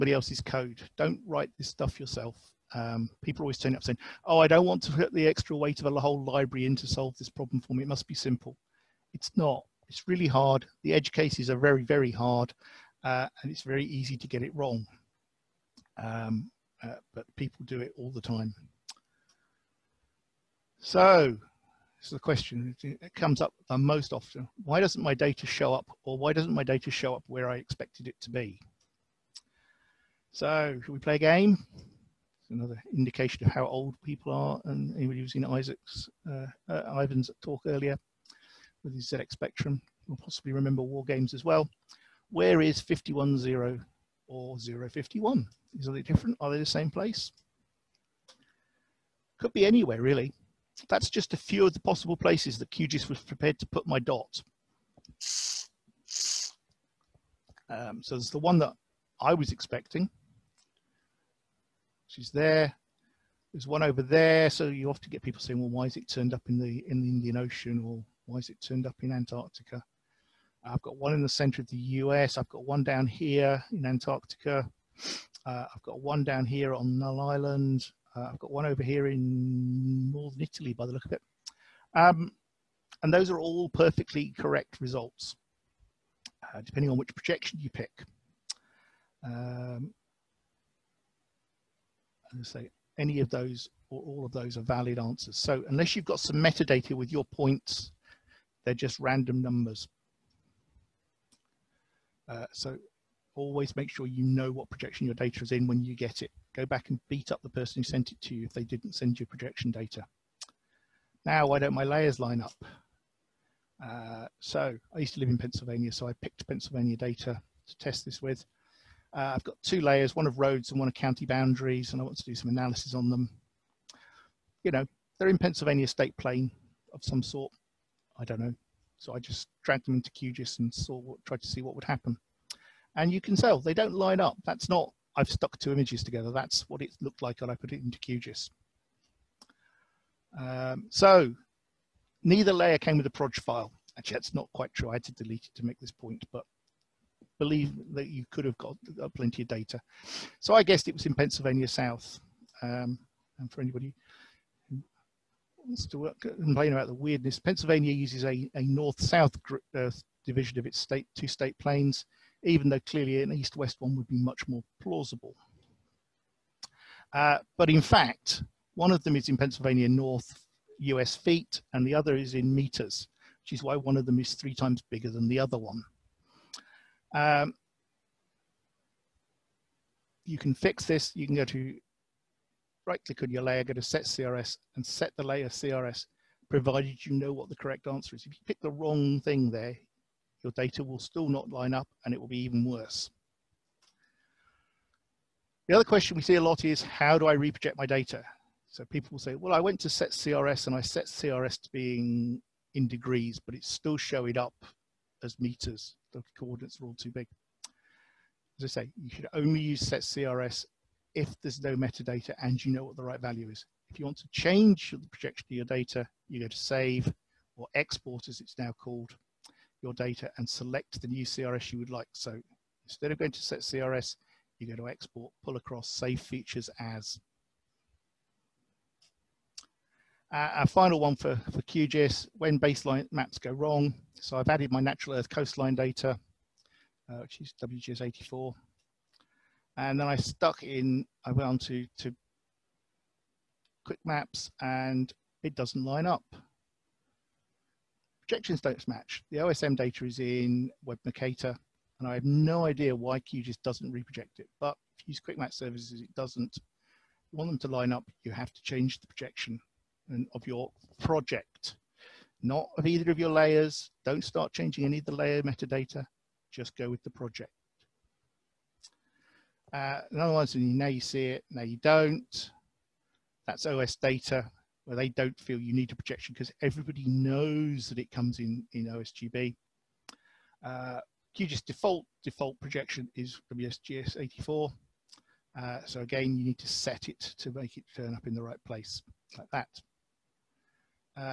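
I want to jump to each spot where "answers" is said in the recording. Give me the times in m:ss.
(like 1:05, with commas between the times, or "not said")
1:34, 3:07.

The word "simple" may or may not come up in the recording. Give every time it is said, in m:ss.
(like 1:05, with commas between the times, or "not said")
0:08.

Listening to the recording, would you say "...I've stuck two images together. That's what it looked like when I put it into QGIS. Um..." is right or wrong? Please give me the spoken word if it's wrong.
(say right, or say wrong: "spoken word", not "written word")
right.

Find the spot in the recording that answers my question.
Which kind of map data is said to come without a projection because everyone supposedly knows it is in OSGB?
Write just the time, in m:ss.
4:33.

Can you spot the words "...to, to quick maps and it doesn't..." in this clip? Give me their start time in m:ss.
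4:01.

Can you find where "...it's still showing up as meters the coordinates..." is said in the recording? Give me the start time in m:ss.
3:23.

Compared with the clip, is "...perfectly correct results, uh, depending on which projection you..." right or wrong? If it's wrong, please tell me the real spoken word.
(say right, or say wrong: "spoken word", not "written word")
right.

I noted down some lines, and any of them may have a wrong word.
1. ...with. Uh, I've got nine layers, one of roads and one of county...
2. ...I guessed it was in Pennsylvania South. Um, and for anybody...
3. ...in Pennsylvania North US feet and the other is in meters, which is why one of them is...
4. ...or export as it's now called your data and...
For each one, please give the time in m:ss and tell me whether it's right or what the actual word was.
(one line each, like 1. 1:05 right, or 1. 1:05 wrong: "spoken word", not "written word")
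1. 1:58 wrong: "two", not "nine"
2. 2:30 right
3. 2:49 right
4. 3:37 right.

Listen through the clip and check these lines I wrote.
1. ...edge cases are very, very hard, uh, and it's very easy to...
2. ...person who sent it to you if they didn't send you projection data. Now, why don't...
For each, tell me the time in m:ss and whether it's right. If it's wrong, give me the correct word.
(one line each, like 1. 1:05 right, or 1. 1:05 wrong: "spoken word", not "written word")
1. 0:10 right
2. 1:47 right.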